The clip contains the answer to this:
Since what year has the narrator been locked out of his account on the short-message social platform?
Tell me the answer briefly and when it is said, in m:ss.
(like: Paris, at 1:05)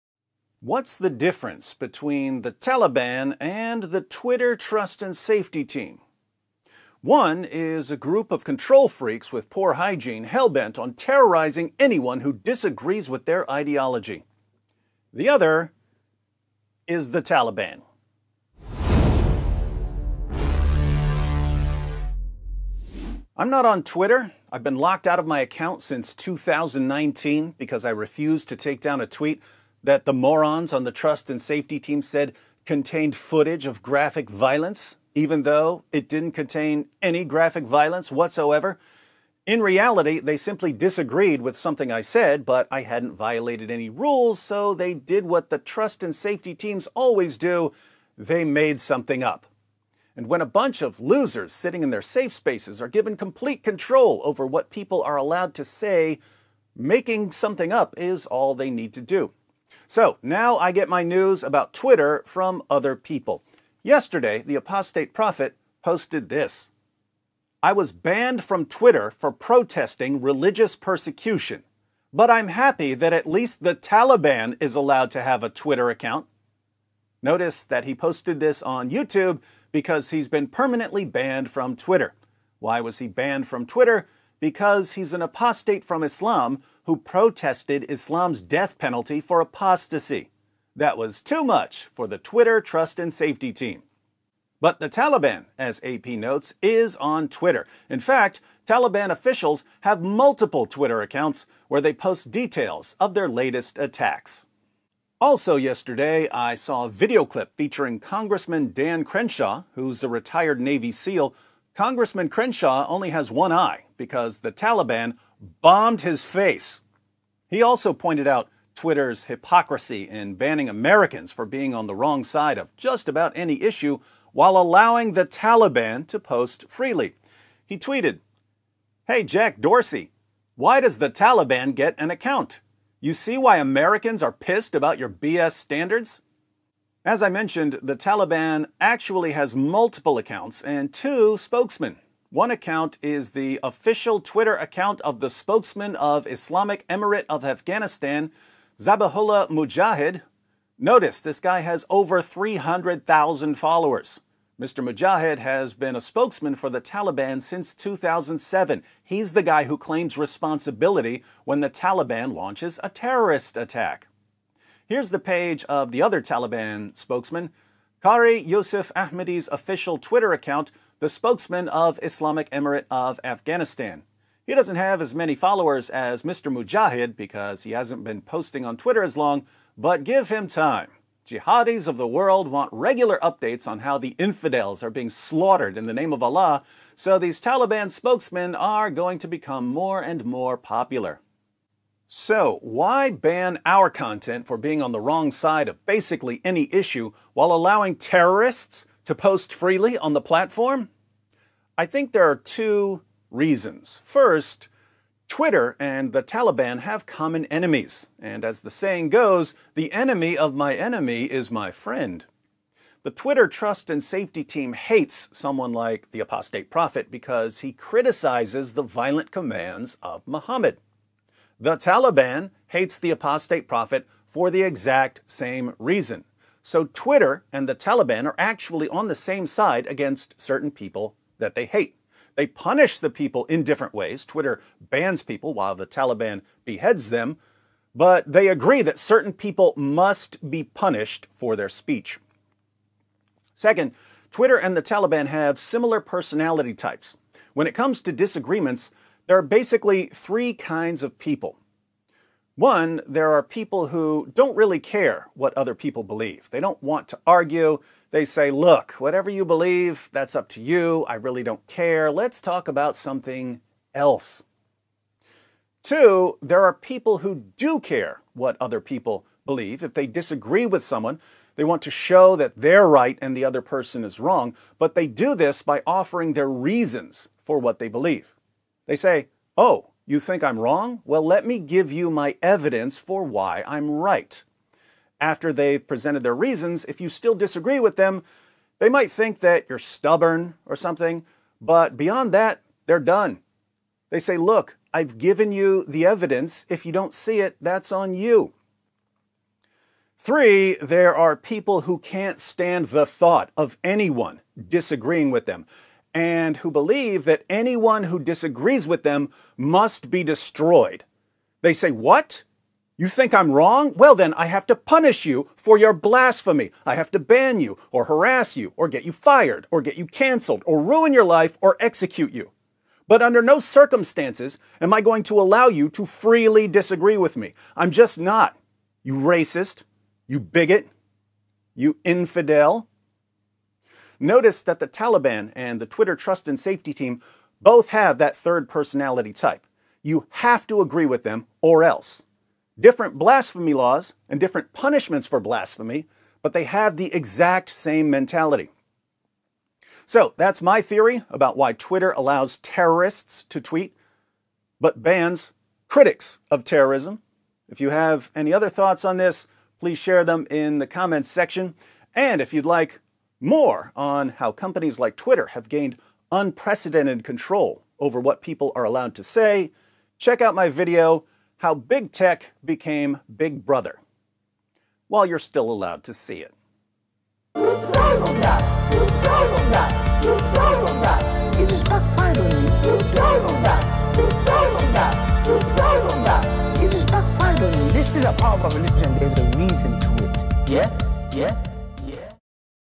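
2019, at 0:26.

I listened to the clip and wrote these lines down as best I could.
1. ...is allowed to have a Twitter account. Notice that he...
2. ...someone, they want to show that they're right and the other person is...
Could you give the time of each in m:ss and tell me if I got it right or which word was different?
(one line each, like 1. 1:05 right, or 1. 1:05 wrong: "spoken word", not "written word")
1. 1:14 right
2. 4:30 right.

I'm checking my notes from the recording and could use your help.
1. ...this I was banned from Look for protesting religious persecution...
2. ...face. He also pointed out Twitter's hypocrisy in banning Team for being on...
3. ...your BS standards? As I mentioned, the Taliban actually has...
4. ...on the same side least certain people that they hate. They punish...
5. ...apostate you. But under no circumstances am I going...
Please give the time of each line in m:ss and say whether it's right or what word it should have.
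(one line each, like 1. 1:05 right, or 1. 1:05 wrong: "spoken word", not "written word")
1. 1:06 wrong: "Twitter", not "Look"
2. 1:56 wrong: "Americans", not "Team"
3. 2:14 right
4. 3:48 wrong: "against", not "least"
5. 5:21 wrong: "execute", not "apostate".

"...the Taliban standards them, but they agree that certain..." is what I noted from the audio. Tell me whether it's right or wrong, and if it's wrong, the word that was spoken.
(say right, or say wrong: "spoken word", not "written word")
wrong: "beheads", not "standards".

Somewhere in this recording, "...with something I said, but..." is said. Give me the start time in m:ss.
0:41.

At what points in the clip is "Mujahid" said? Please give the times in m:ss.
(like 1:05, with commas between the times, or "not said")
2:29, 2:34, 2:56.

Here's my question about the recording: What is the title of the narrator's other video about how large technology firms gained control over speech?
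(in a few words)
How Big Tech Became Big Brother.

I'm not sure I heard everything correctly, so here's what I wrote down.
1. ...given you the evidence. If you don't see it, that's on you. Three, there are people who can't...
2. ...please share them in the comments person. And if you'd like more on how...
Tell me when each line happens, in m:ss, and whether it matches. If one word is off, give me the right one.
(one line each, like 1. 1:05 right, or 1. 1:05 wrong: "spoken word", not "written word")
1. 4:55 right
2. 5:59 wrong: "section", not "person".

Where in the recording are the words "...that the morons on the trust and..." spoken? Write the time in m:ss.
0:29.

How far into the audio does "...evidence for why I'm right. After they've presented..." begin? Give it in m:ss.
4:42.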